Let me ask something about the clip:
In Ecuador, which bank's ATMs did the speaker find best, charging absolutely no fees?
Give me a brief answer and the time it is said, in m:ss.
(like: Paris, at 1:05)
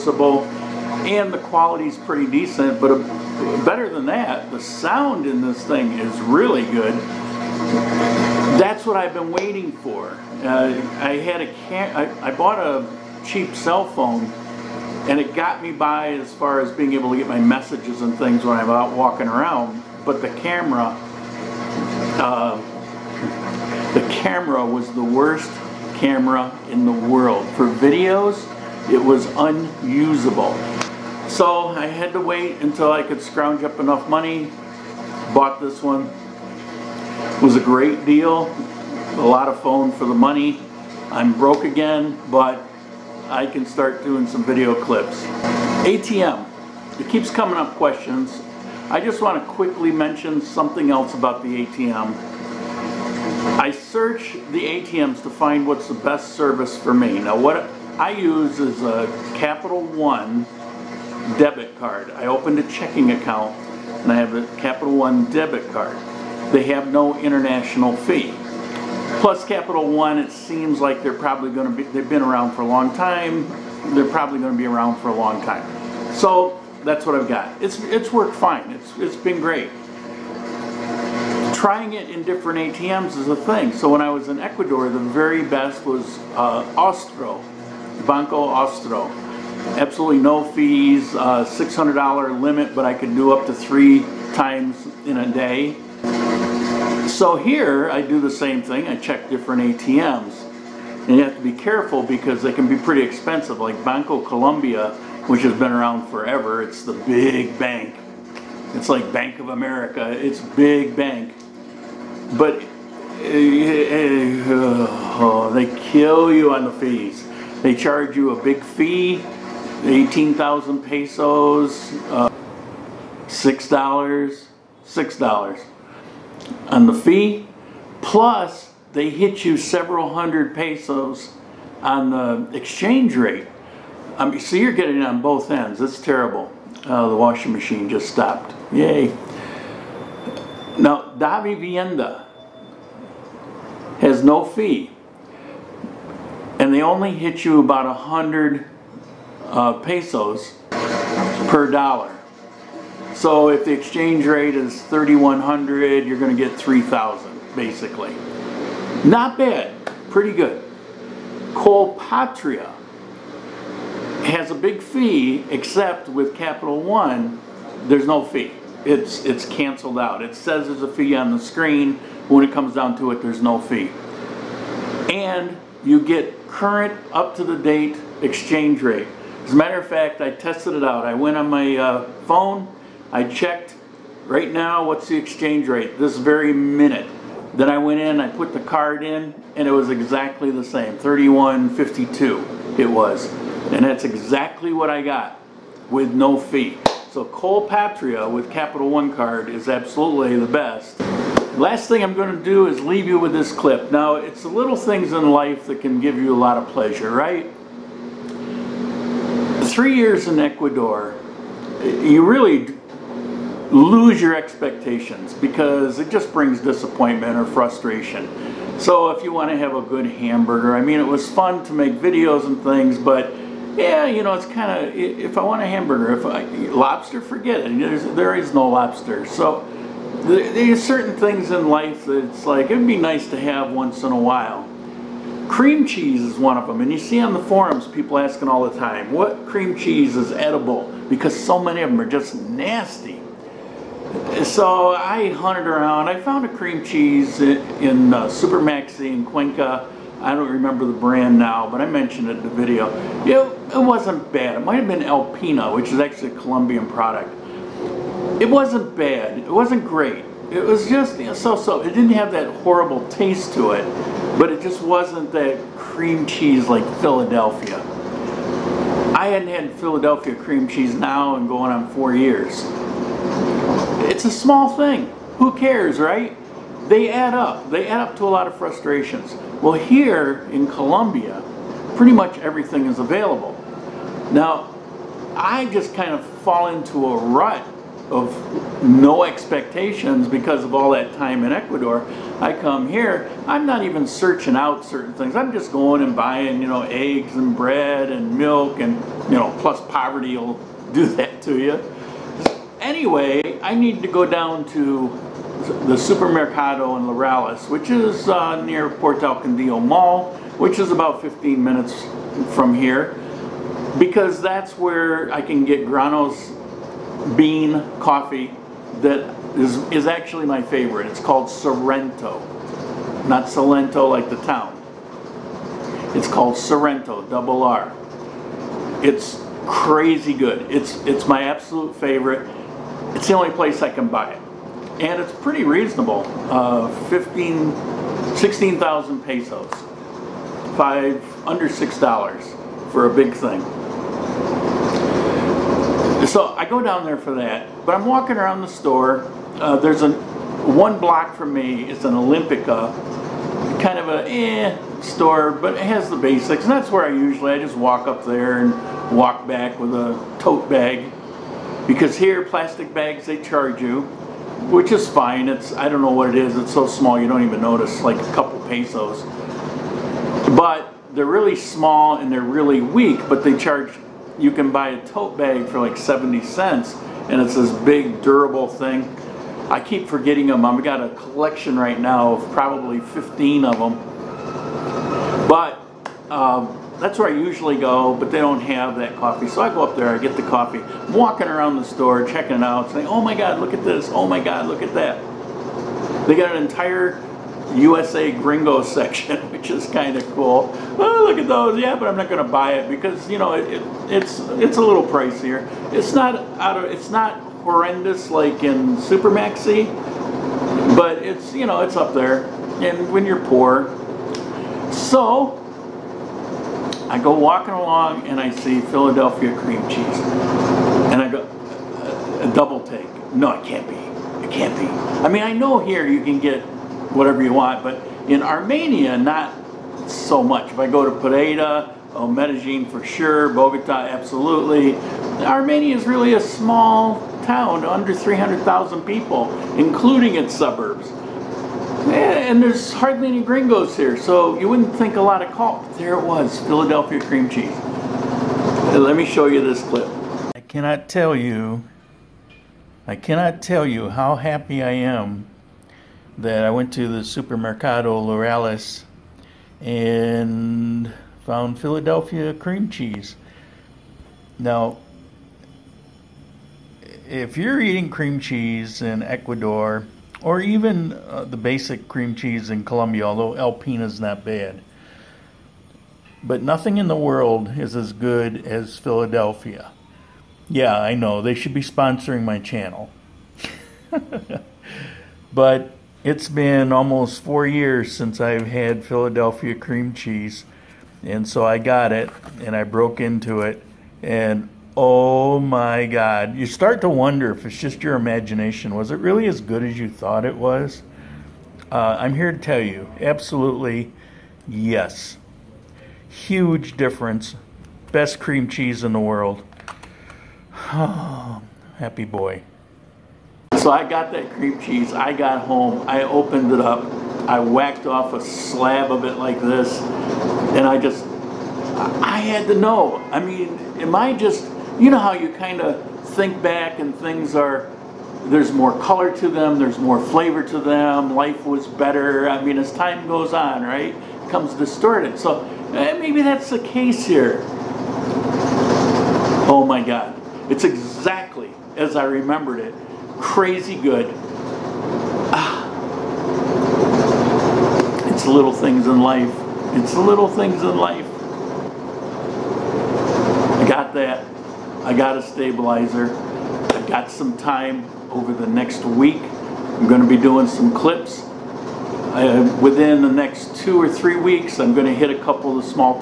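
Banco Austro, at 1:28.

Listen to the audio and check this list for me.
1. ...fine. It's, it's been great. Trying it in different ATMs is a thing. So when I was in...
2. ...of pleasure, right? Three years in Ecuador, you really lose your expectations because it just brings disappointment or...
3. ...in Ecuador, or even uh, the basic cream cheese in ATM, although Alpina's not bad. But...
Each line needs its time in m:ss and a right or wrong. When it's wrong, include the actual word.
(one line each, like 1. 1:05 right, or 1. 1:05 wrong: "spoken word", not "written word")
1. 1:18 right
2. 3:26 right
3. 7:49 wrong: "Colombia", not "ATM".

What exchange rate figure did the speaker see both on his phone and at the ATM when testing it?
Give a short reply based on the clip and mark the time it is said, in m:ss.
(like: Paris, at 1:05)
31.52, at 3:10.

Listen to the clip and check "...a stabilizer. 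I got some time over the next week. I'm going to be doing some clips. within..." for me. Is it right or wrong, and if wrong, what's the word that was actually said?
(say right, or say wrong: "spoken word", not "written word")
right.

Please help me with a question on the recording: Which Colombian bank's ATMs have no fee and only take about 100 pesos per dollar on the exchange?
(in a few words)
Davivienda.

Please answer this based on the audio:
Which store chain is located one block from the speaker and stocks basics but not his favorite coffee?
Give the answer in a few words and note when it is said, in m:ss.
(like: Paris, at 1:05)
Olímpica, at 5:52.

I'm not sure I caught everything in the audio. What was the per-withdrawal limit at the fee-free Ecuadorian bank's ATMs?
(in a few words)
$600.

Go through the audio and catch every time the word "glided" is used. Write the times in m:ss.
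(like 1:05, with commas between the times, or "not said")
not said.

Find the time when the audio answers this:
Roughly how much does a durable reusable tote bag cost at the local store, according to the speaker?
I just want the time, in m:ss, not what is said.
6:15.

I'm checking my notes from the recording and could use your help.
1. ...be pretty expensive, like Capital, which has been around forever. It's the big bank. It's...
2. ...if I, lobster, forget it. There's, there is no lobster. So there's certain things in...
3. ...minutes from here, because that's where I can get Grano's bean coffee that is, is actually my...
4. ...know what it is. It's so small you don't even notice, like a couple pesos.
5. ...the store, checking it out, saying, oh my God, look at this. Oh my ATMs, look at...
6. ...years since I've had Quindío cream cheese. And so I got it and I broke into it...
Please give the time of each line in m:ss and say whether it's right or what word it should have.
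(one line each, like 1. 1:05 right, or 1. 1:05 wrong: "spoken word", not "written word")
1. 1:42 wrong: "Bancolombia", not "Capital"
2. 3:46 right
3. 5:11 right
4. 6:06 right
5. 6:31 wrong: "God", not "ATMs"
6. 8:07 wrong: "Philadelphia", not "Quindío".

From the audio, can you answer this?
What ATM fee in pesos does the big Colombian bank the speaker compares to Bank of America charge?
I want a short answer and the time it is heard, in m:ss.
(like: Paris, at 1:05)
18,000 pesos, at 1:59.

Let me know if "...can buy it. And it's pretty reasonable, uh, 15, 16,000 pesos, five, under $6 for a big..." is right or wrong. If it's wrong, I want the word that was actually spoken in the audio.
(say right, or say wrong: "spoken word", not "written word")
right.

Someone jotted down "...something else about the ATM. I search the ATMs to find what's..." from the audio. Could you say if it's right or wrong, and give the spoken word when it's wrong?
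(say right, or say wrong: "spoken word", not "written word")
right.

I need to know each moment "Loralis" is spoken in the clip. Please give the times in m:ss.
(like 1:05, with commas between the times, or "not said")
5:07, 7:38.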